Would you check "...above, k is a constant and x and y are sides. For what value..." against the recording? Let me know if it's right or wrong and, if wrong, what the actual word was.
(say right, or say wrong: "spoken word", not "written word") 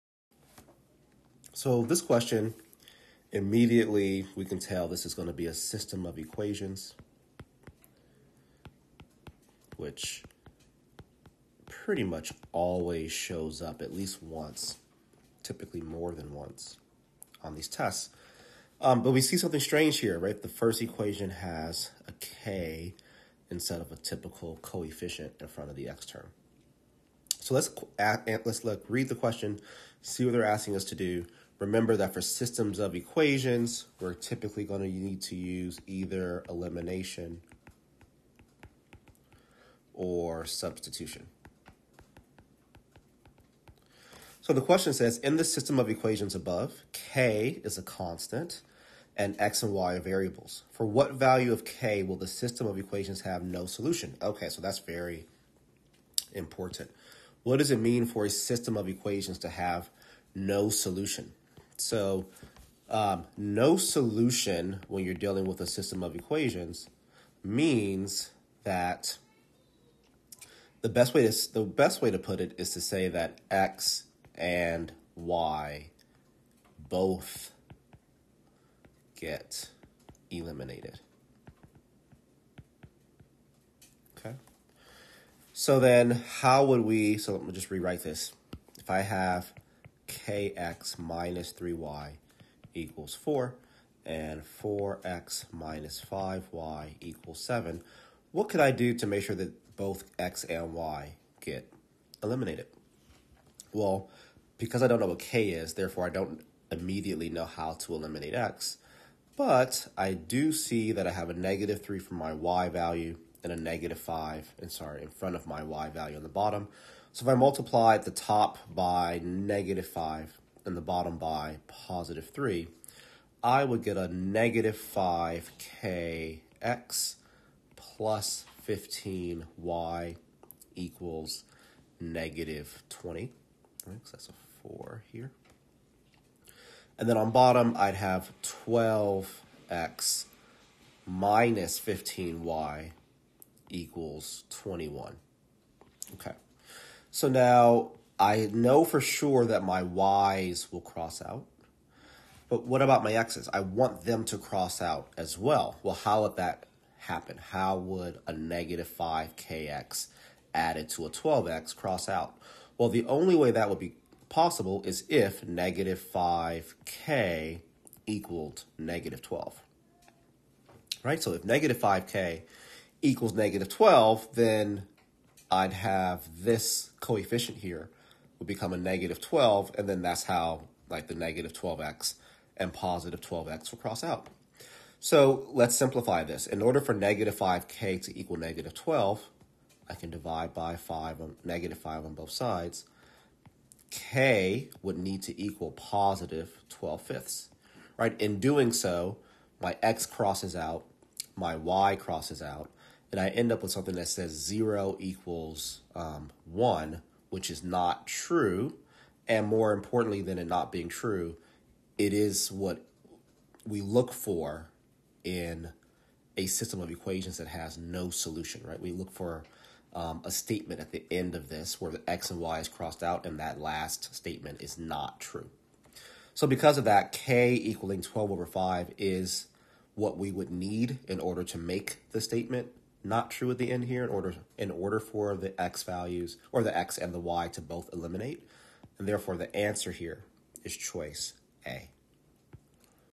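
wrong: "variables", not "sides".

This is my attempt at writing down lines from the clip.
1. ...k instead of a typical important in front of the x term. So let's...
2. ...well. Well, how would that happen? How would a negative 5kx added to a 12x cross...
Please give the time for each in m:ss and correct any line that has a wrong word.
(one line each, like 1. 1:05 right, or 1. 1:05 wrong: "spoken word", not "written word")
1. 0:22 wrong: "coefficient", not "important"
2. 2:35 right.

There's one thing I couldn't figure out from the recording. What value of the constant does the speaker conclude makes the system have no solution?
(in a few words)
12/5.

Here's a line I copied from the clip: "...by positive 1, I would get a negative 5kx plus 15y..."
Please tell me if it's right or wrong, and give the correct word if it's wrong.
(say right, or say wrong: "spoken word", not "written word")
wrong: "3", not "1".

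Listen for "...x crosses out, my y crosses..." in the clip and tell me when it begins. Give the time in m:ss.
3:19.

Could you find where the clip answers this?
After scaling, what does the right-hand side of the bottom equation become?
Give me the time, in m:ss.
2:24.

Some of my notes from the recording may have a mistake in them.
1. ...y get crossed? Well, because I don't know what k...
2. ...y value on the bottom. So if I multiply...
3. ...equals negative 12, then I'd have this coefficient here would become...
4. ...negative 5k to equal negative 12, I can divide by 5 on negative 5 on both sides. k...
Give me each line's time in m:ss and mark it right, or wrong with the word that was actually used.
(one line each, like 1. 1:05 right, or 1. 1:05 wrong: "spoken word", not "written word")
1. 1:40 wrong: "eliminated", not "crossed"
2. 1:55 right
3. 2:53 right
4. 3:06 right.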